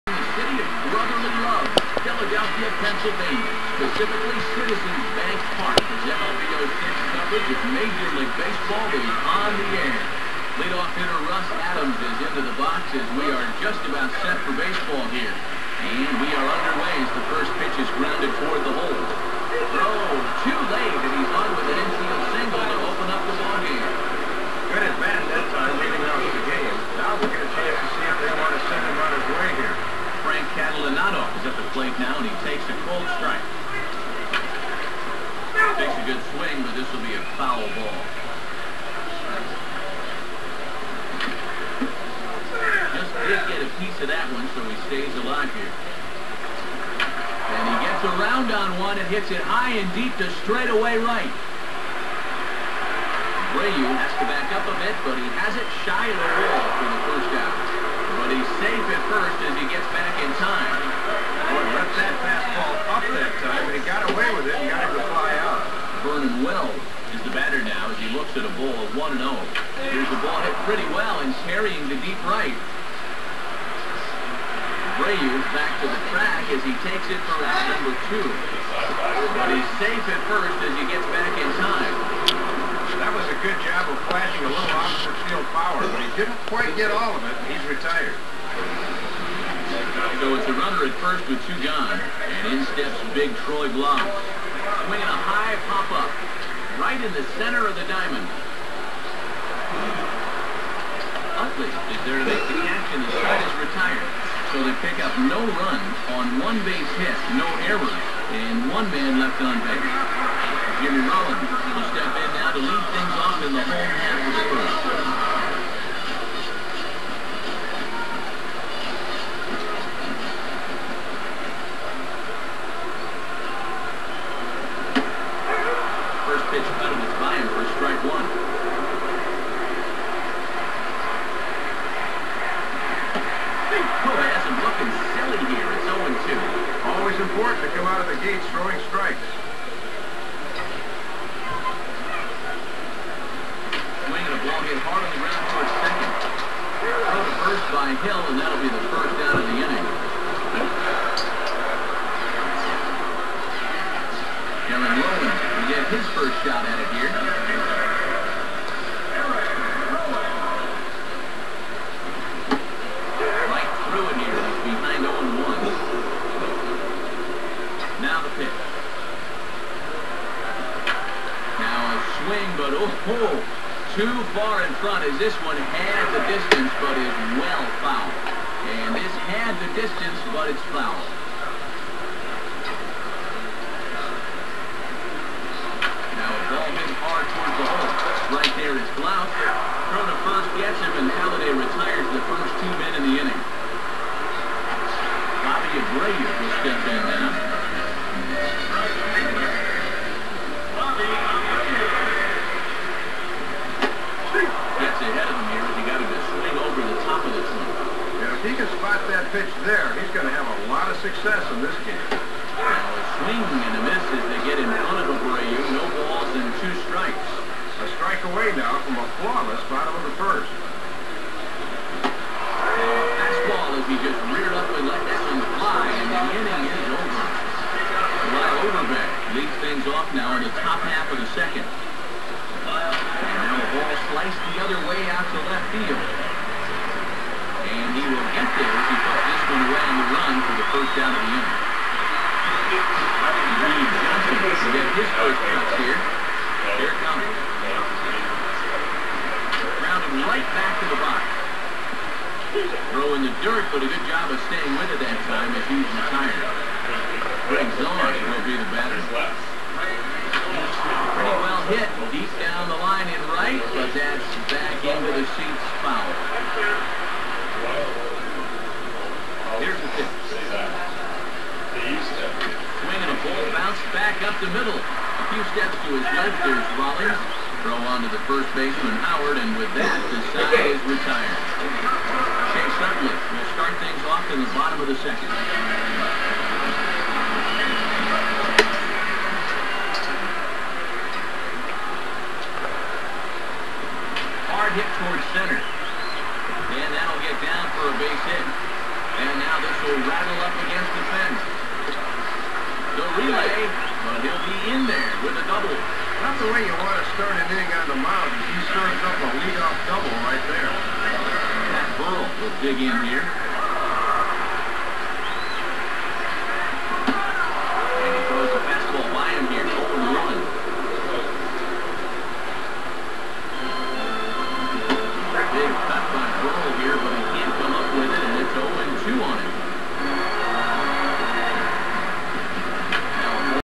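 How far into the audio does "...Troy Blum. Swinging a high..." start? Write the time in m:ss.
1:33.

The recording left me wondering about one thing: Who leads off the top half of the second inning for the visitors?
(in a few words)
Lyle Overbay.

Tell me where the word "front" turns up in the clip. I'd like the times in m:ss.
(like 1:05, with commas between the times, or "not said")
2:54, 3:34.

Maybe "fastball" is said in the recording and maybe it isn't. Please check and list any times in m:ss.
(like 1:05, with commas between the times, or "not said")
1:02, 3:42.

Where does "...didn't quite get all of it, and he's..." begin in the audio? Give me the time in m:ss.
1:26.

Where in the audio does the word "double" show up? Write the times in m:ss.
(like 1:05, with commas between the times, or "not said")
5:05, 5:09.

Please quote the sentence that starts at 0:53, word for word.
Abreu has to back up a bit, but he has it shy of the wall for the first out.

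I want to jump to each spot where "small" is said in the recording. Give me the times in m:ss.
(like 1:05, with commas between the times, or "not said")
not said.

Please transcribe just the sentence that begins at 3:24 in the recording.
Gets ahead of him here he got him to swing over the top of the trunk.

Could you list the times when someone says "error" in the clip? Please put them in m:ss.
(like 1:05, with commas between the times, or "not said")
1:47.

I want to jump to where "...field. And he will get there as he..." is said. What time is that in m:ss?
3:55.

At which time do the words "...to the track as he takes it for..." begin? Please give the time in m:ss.
1:15.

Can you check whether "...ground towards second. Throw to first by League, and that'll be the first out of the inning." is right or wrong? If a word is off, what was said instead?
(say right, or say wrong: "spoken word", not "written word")
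wrong: "Hill", not "League".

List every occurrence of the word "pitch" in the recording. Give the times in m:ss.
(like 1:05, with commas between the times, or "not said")
0:17, 2:06, 2:48, 3:29, 4:29.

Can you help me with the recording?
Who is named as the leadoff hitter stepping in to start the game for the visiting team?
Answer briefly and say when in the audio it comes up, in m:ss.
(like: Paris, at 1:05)
Russ Adams, at 0:11.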